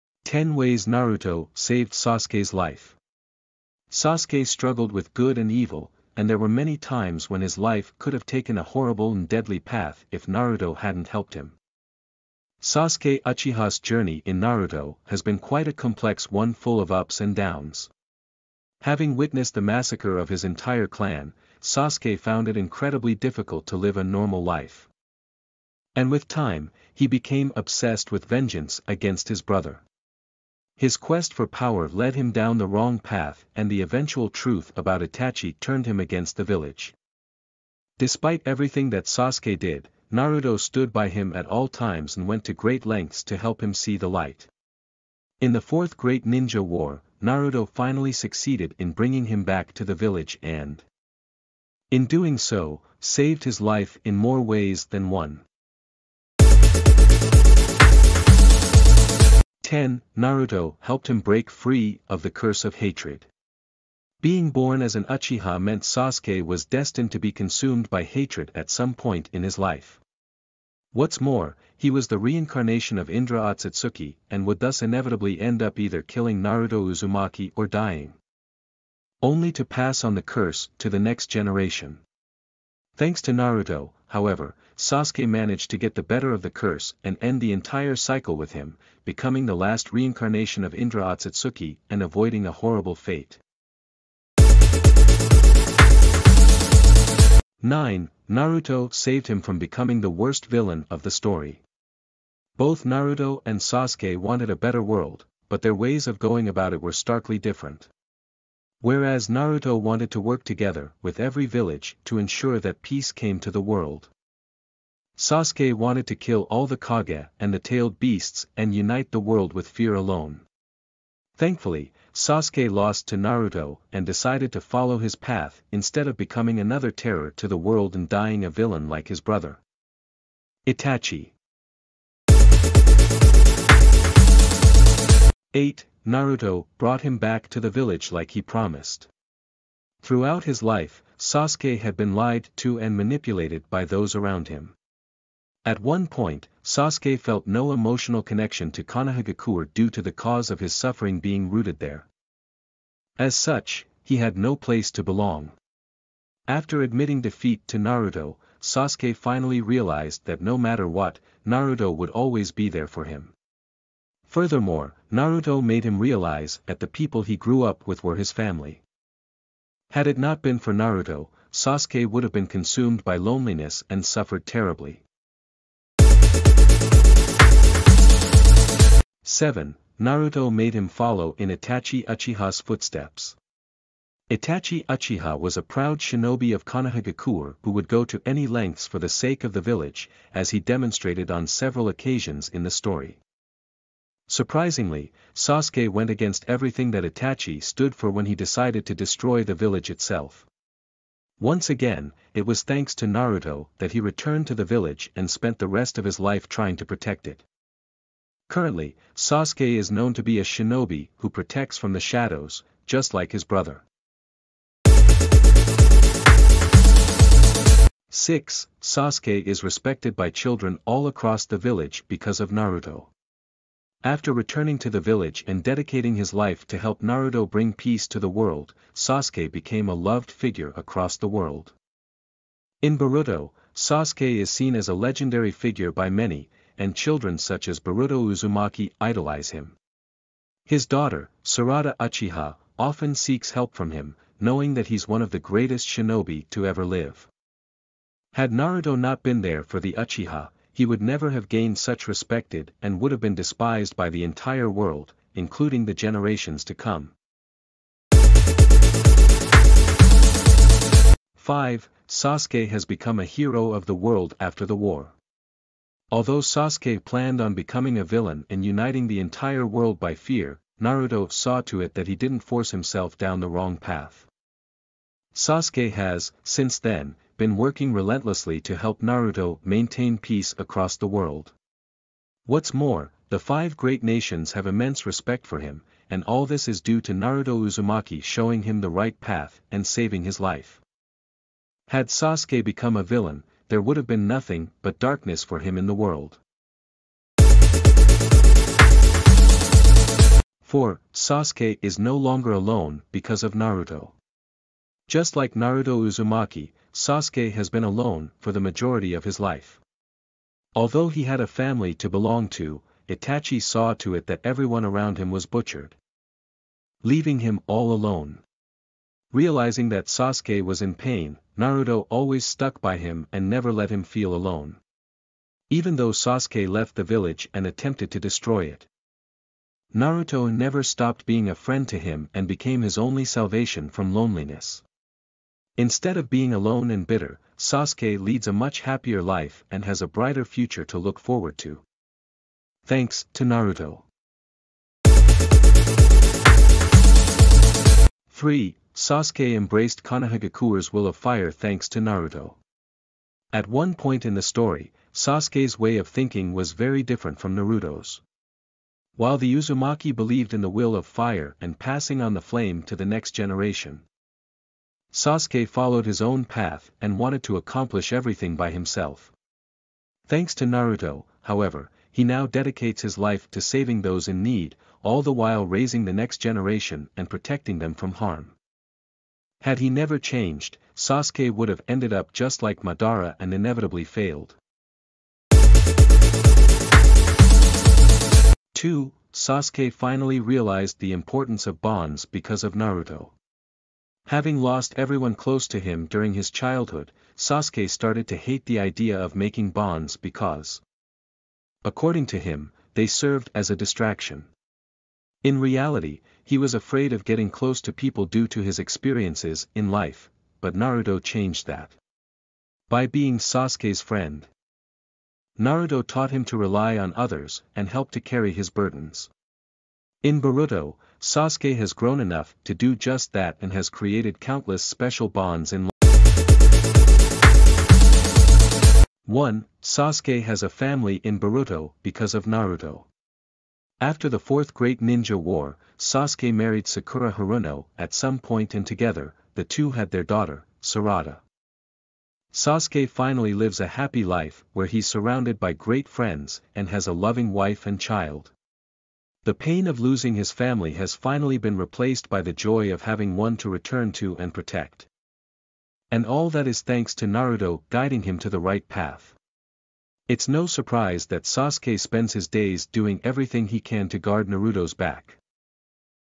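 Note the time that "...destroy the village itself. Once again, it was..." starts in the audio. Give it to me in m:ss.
3:18.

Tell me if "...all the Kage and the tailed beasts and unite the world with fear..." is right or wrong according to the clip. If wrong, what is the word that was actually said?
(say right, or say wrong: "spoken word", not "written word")
right.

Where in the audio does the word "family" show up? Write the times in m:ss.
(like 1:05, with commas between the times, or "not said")
2:48, 5:11, 7:10, 7:30.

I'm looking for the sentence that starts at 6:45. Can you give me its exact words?
In reality, he was afraid of getting close to people due to his experiences in life, but Naruto changed that.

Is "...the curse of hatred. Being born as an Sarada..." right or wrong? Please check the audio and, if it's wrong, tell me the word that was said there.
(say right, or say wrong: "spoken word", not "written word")
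wrong: "Uchiha", not "Sarada".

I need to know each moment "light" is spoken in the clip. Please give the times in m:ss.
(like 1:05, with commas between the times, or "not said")
0:44.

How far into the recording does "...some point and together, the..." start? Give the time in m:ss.
7:18.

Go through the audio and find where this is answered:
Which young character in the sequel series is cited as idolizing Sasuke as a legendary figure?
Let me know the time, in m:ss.
3:57.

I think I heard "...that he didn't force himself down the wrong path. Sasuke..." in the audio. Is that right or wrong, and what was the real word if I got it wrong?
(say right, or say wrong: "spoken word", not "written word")
right.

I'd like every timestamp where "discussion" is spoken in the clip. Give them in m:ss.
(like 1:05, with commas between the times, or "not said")
not said.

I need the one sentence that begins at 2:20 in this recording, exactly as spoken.
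Throughout his life, Sasuke had been lied to and manipulated by those around him.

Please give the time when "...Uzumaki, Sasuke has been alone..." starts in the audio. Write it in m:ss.
5:06.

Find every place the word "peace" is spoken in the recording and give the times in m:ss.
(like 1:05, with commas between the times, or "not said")
1:52, 3:47, 4:40.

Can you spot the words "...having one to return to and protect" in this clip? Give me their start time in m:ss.
7:33.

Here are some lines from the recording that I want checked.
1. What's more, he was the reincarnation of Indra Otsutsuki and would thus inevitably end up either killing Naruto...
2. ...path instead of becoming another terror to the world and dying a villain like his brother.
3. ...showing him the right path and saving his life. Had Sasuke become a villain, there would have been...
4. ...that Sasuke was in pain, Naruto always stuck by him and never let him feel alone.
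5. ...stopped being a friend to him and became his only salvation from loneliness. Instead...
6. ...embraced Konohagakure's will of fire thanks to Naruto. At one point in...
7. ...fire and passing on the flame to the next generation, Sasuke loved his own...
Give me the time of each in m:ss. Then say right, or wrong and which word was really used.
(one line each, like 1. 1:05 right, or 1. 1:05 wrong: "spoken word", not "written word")
1. 1:10 right
2. 2:05 right
3. 4:48 right
4. 5:19 right
5. 5:30 right
6. 5:49 right
7. 6:01 wrong: "followed", not "loved".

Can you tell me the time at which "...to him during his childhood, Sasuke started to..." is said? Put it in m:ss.
6:35.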